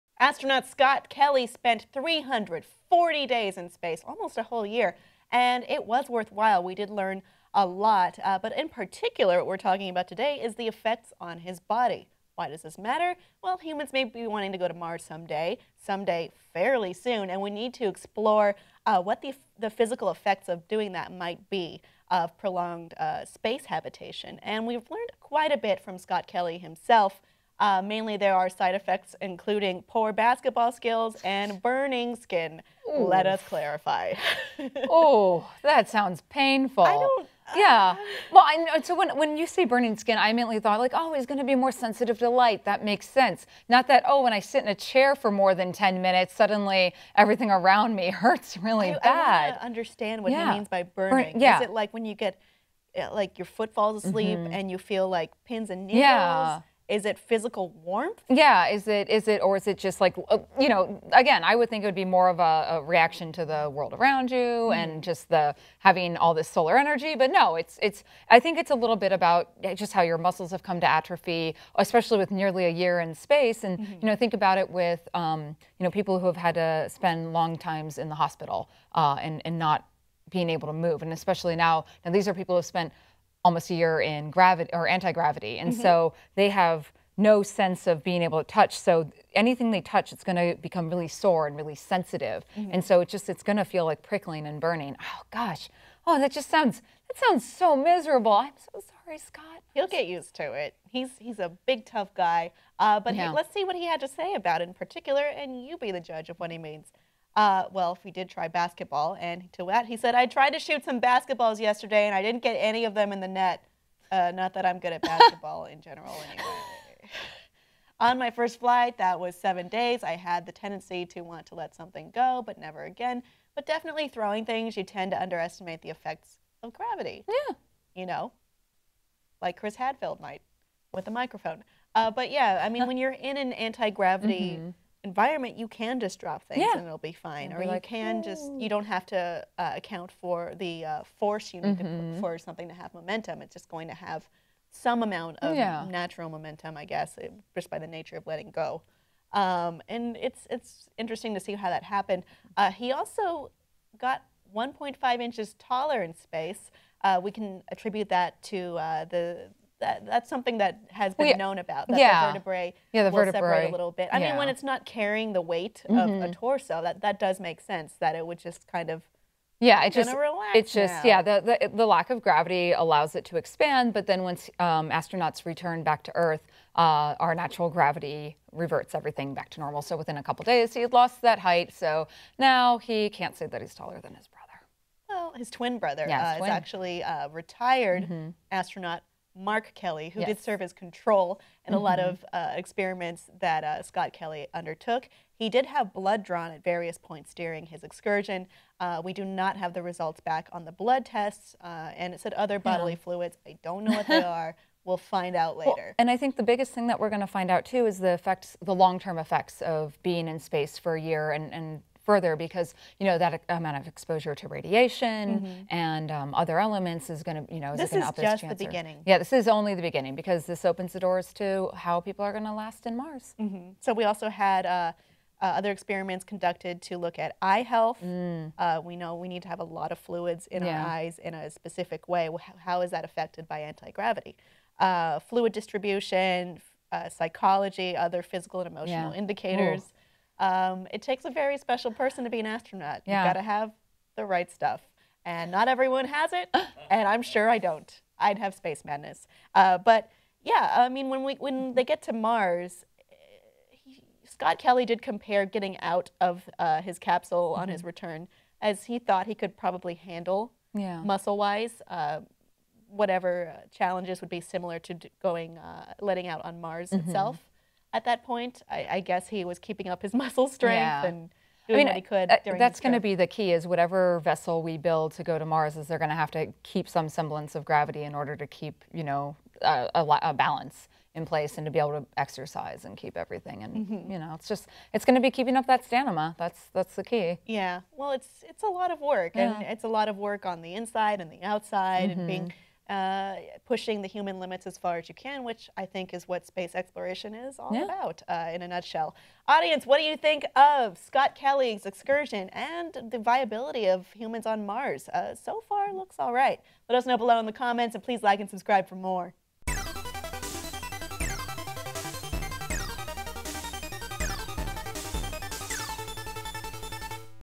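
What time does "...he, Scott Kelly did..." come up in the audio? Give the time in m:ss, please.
4:13.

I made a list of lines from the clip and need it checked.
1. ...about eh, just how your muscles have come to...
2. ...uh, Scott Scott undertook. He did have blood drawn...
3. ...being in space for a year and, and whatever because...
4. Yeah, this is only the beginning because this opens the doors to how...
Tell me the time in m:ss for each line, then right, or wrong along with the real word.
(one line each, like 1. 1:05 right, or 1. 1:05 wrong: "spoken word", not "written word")
1. 1:09 right
2. 3:13 wrong: "Kelly", not "Scott"
3. 3:30 wrong: "further", not "whatever"
4. 3:39 right.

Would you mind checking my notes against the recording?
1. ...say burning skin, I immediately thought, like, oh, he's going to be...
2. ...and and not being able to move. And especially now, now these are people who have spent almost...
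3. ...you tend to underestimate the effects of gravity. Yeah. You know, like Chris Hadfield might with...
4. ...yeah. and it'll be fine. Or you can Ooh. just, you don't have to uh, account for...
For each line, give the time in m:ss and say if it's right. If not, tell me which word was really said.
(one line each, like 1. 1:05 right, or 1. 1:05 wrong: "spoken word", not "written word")
1. 0:39 right
2. 1:19 right
3. 2:04 right
4. 2:16 right.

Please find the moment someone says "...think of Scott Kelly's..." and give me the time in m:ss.
5:00.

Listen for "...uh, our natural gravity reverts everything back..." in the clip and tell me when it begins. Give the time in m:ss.
2:56.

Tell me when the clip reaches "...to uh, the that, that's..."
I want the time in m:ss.
2:38.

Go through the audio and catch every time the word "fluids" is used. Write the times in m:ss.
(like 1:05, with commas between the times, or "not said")
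3:23, 3:49, 3:55.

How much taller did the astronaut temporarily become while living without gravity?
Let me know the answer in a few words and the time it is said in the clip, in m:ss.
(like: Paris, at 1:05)
1.5 inches, at 2:34.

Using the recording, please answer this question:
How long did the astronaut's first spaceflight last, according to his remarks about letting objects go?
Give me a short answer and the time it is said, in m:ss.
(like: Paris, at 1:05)
7 days, at 1:59.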